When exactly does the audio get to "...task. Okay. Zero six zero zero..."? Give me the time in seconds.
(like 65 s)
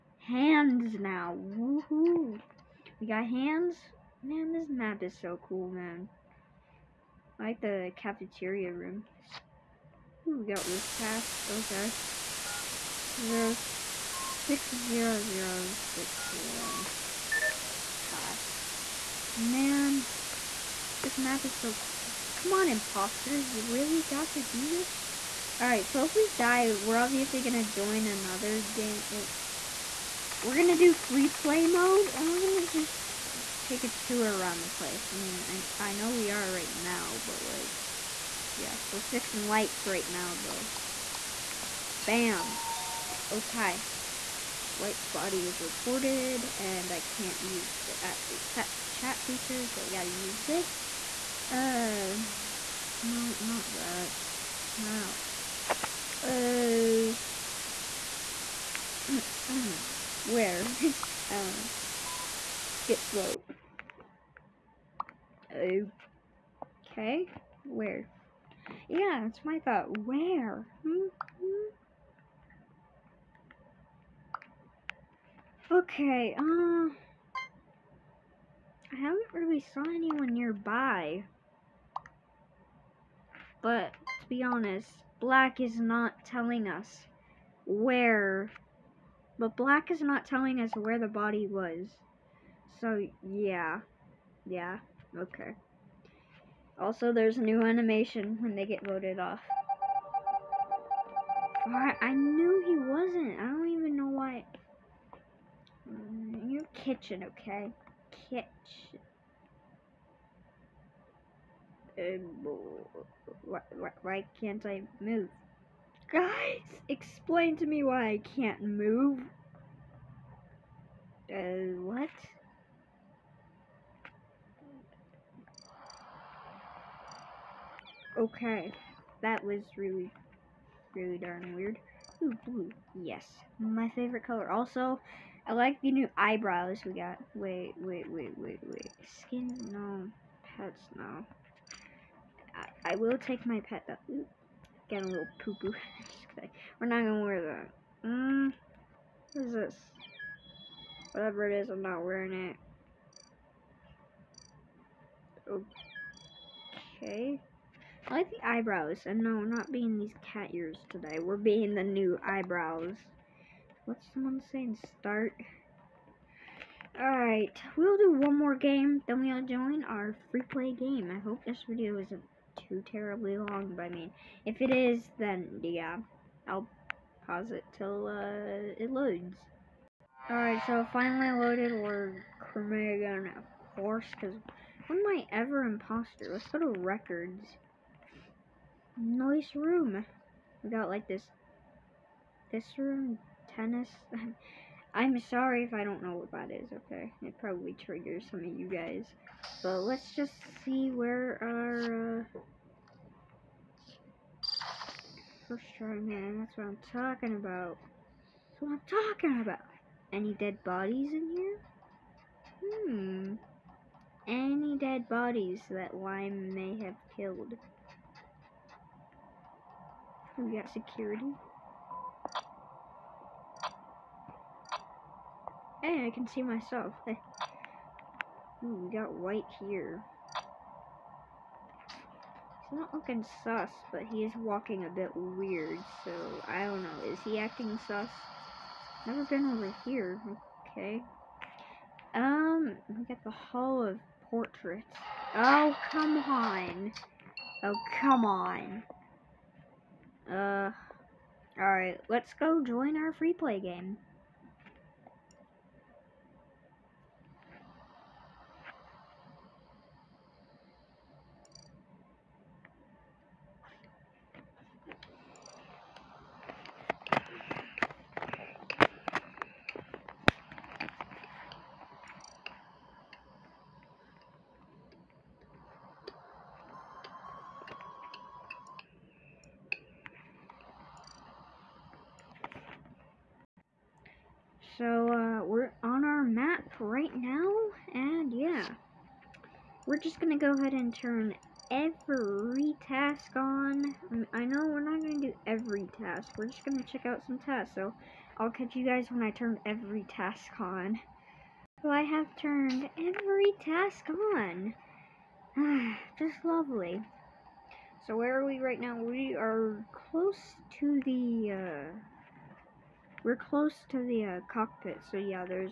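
10 s.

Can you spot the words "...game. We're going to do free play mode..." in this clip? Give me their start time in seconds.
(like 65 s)
28 s.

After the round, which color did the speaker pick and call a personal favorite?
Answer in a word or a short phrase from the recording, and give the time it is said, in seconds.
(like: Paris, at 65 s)
Blue, at 132 s.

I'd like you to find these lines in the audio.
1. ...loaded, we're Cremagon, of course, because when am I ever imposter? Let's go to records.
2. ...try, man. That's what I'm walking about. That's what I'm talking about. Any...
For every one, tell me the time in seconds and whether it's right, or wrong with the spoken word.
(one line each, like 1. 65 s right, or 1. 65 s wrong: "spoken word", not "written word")
1. 181 s right
2. 205 s wrong: "talking", not "walking".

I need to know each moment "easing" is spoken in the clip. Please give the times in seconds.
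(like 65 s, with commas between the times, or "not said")
not said.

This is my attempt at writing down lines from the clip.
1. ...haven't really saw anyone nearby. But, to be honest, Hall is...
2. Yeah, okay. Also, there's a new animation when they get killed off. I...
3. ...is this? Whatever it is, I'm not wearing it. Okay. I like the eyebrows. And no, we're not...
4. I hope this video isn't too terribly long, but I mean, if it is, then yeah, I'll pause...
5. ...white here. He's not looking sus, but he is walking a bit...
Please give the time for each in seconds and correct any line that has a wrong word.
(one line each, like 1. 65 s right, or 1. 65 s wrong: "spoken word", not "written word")
1. 78 s wrong: "Black", not "Hall"
2. 94 s wrong: "voted", not "killed"
3. 149 s right
4. 171 s right
5. 229 s right.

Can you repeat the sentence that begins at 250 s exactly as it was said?
Uh, alright, let's go join our free play game.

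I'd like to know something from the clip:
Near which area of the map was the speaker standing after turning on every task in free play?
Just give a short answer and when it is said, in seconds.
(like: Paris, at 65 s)
Cockpit, at 314 s.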